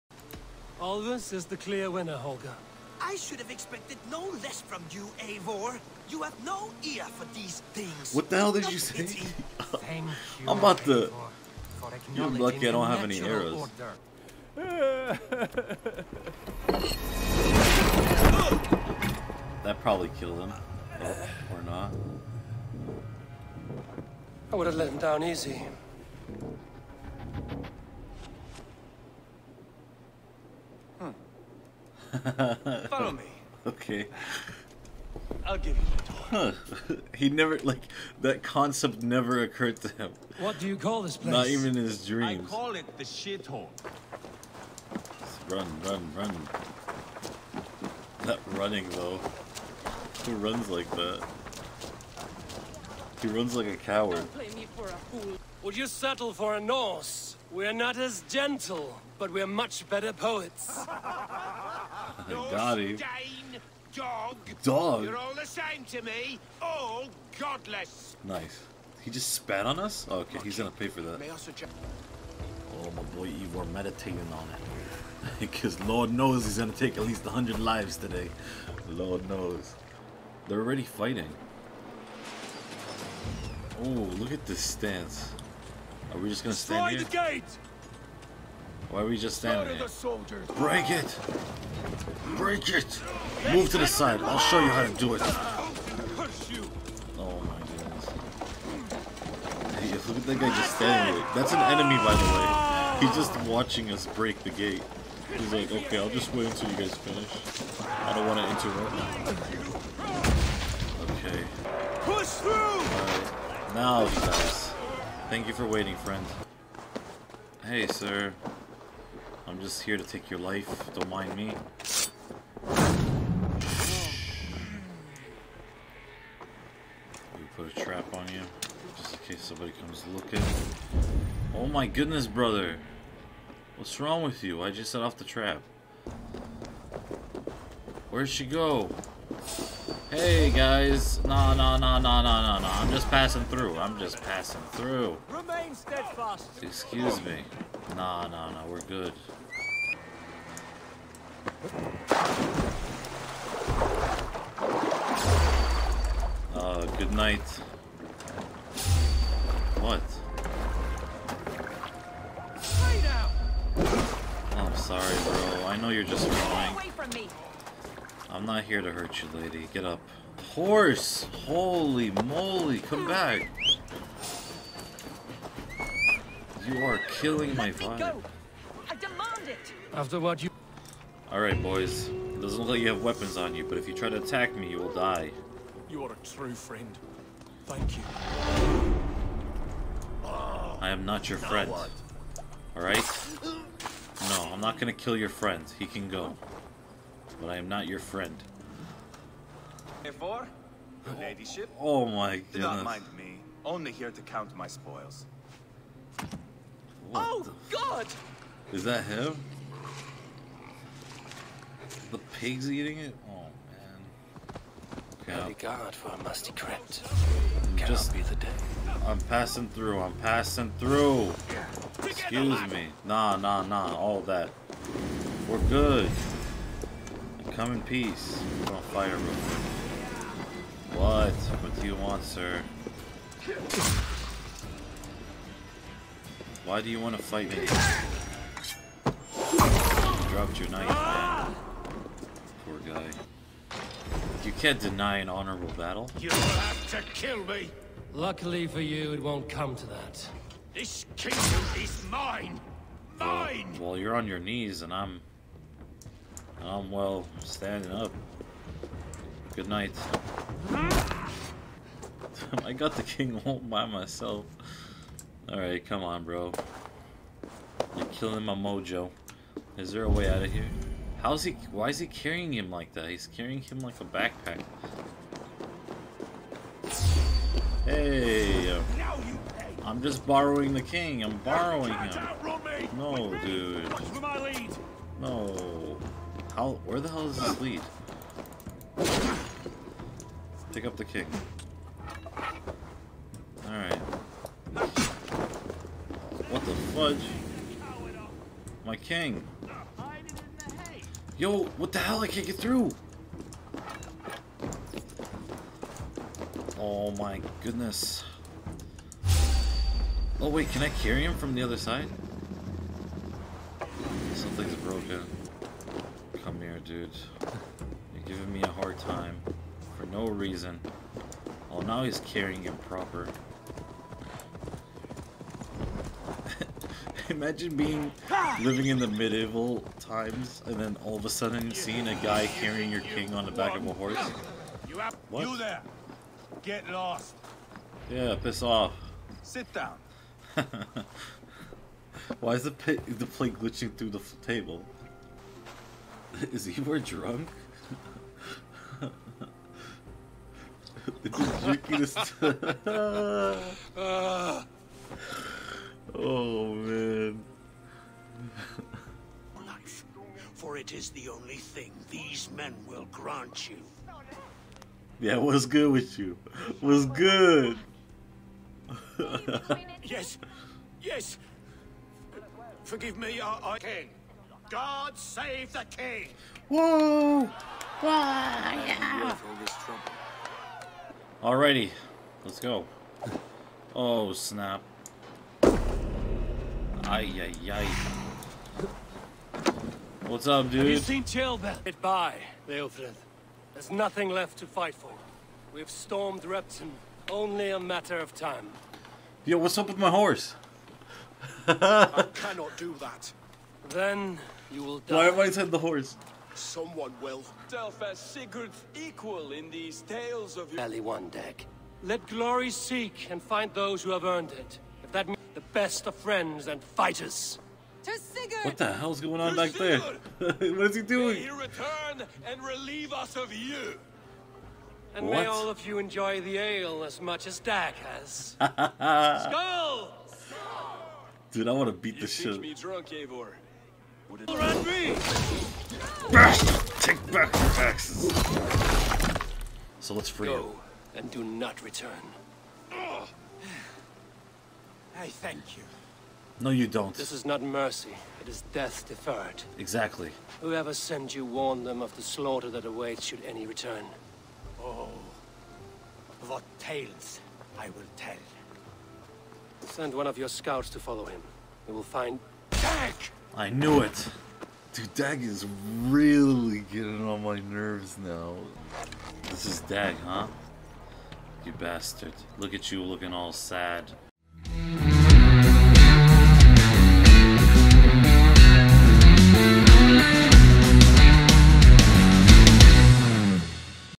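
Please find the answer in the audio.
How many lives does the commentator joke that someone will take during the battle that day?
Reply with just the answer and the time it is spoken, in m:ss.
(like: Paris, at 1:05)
100, at 1:17.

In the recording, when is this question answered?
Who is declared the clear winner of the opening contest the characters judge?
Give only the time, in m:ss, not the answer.
0:00.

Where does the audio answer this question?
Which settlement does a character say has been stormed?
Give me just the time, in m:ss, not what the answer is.
6:36.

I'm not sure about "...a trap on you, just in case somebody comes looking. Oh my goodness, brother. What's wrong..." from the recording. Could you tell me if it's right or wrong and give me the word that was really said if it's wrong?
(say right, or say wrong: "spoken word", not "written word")
right.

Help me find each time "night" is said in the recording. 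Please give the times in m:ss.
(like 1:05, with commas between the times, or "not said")
2:37, 4:19.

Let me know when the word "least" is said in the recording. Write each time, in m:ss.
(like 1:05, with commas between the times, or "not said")
1:17.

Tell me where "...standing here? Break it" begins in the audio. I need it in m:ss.
1:29.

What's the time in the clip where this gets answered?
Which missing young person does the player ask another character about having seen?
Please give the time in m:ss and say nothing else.
6:31.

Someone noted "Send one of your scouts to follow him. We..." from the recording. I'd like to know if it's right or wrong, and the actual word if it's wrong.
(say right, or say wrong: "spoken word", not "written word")
right.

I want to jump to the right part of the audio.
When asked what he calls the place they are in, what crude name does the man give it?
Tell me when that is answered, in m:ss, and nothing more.
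0:42.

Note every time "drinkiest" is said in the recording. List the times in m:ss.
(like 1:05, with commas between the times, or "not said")
5:51.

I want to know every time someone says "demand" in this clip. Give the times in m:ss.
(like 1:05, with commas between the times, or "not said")
2:58.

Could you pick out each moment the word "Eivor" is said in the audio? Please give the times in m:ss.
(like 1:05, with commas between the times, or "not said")
0:05, 3:20, 7:13.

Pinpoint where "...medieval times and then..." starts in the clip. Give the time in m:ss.
5:29.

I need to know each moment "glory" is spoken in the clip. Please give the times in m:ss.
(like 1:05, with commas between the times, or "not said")
6:52.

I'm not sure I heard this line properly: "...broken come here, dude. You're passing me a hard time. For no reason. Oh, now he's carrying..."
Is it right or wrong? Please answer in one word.
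wrong.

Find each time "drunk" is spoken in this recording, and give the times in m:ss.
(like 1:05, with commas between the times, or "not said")
5:46, 7:12.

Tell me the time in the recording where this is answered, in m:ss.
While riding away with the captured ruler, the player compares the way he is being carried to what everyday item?
4:33.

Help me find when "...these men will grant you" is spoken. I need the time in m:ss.
6:02.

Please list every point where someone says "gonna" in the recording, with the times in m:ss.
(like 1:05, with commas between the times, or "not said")
1:10, 1:16, 1:26, 3:14.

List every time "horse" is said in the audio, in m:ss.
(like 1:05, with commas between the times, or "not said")
2:50, 5:33, 6:40, 6:45.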